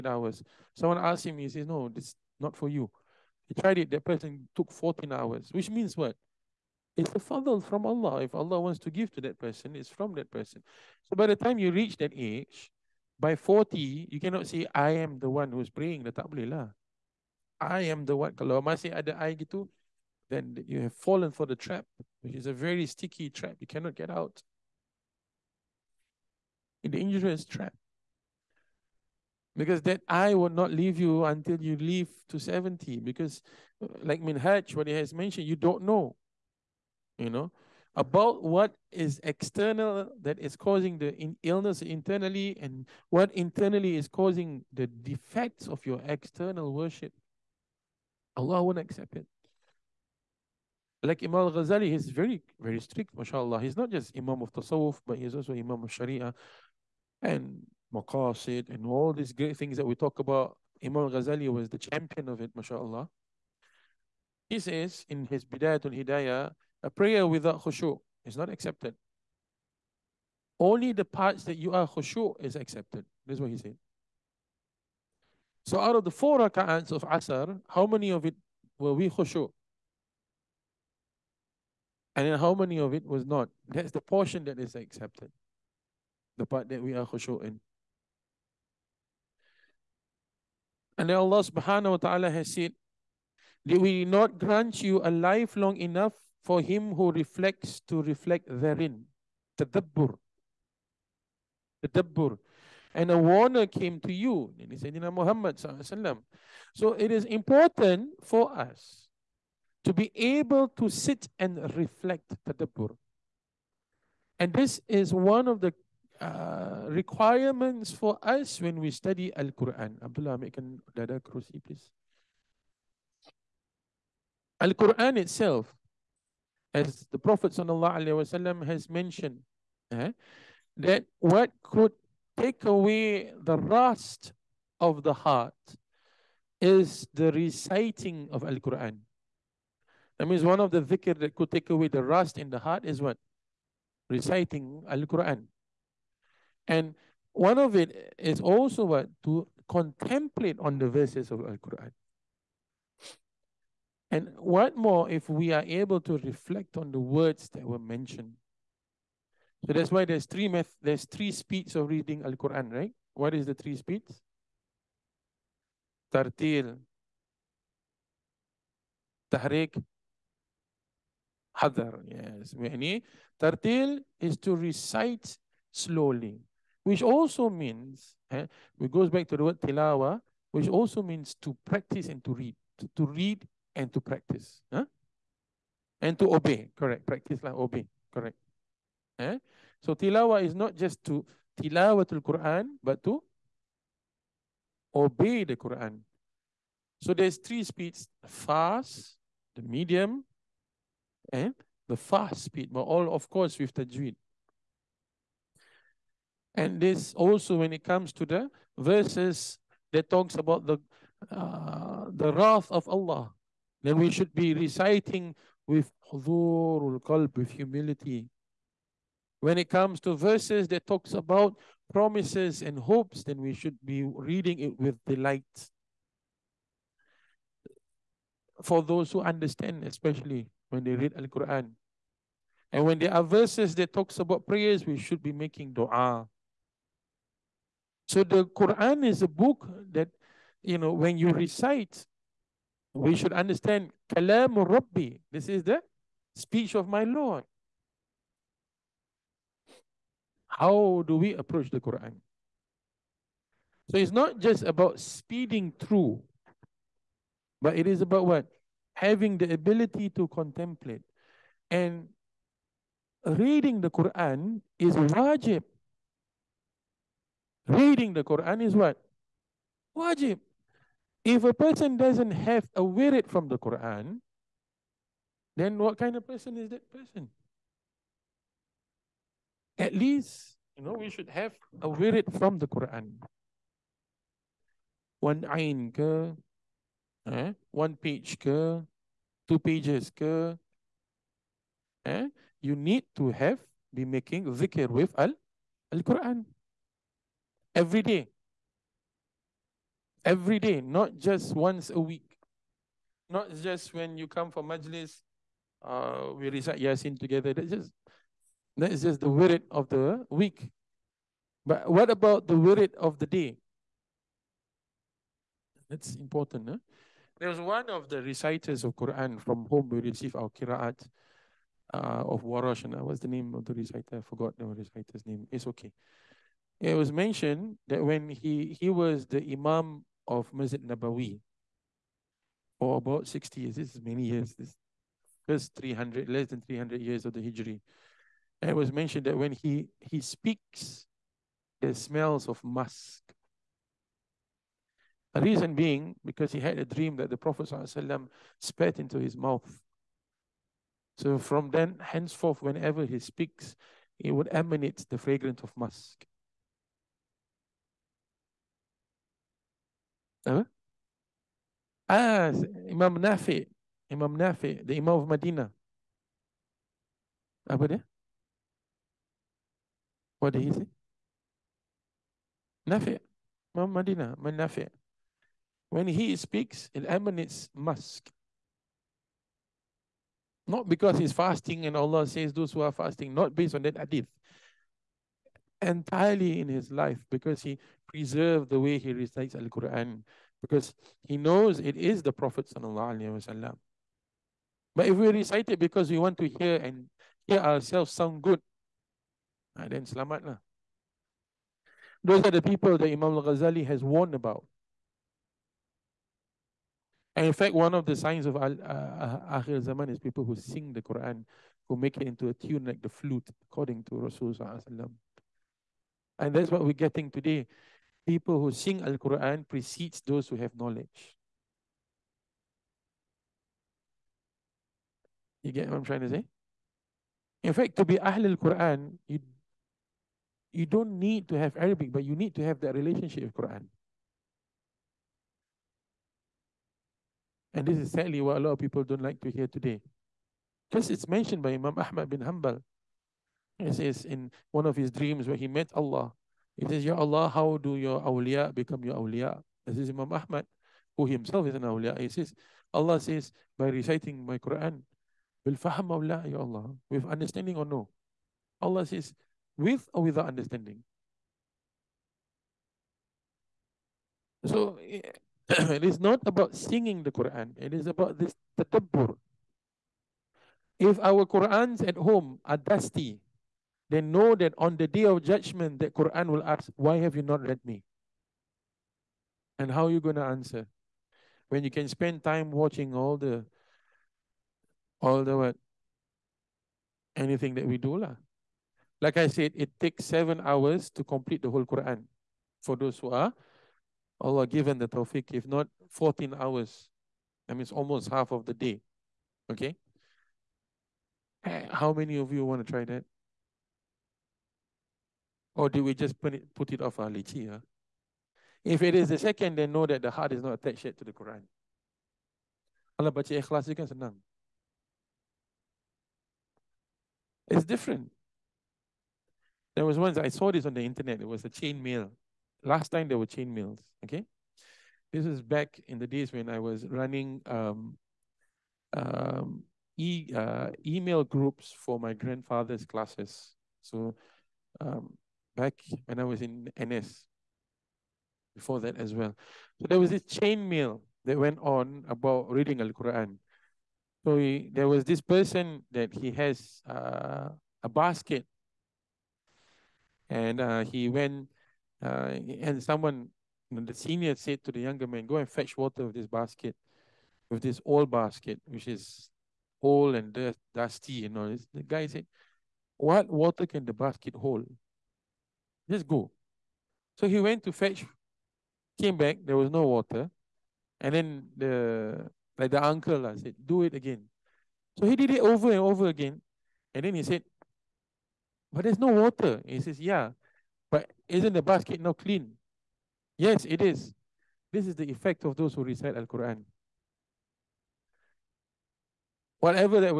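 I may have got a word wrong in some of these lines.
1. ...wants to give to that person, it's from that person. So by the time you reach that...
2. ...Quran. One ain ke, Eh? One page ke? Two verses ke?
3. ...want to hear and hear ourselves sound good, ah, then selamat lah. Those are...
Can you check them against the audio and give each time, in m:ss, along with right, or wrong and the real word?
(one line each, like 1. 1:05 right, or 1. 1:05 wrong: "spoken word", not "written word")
1. 0:08 right
2. 4:42 wrong: "pages", not "verses"
3. 6:36 right.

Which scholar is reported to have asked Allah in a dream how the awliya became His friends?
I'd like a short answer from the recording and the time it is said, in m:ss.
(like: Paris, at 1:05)
Imam Ahmad bin Hanbal, at 7:21.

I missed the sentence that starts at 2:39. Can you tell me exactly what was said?
So that's why there's three meth there's three speeds of reading Al Quran, right?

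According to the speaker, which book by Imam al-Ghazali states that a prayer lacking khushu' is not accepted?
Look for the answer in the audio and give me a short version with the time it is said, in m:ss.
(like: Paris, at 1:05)
Bidayatul Hidayah, at 1:05.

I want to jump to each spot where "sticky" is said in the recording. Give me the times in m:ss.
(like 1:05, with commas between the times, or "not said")
0:22.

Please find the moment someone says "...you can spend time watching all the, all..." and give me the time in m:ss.
8:01.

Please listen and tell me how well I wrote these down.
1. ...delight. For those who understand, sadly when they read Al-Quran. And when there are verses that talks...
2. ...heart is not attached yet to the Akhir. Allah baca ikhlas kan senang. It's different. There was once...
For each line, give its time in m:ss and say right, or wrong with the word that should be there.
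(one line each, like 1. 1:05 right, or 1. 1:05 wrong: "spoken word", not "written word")
1. 3:45 wrong: "especially", not "sadly"
2. 8:30 wrong: "Quran", not "Akhir".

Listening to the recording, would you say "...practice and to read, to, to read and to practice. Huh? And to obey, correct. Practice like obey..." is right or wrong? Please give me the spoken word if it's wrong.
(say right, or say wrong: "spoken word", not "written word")
right.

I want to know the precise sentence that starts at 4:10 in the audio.
How do we approach the Quran?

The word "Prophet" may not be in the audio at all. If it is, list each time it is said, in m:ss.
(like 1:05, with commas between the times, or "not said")
2:07, 5:47, 6:32.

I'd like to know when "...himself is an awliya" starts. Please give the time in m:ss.
7:31.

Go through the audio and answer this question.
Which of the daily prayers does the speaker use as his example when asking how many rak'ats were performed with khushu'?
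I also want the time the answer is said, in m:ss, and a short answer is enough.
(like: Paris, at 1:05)
Asr, at 1:17.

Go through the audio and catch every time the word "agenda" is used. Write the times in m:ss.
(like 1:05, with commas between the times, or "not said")
not said.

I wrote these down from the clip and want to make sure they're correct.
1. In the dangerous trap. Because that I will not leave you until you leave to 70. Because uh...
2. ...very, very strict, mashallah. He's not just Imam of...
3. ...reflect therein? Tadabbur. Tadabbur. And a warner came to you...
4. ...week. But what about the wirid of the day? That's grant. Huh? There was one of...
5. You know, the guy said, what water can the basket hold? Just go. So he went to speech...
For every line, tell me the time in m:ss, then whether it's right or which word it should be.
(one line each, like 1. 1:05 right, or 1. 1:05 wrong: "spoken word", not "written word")
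1. 0:26 right
2. 0:52 right
3. 1:38 right
4. 5:10 wrong: "important", not "grant"
5. 9:21 wrong: "fetch", not "speech".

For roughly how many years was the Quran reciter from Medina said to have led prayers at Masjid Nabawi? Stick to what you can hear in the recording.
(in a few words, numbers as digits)
60.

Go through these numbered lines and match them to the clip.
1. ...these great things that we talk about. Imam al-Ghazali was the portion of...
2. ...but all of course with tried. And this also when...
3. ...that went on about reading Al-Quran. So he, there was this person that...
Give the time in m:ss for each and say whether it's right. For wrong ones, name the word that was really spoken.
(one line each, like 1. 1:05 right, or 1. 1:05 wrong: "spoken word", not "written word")
1. 0:59 wrong: "champion", not "portion"
2. 3:22 wrong: "tajweed", not "tried"
3. 9:01 right.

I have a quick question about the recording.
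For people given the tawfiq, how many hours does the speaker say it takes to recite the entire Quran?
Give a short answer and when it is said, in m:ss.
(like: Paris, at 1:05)
7, at 8:10.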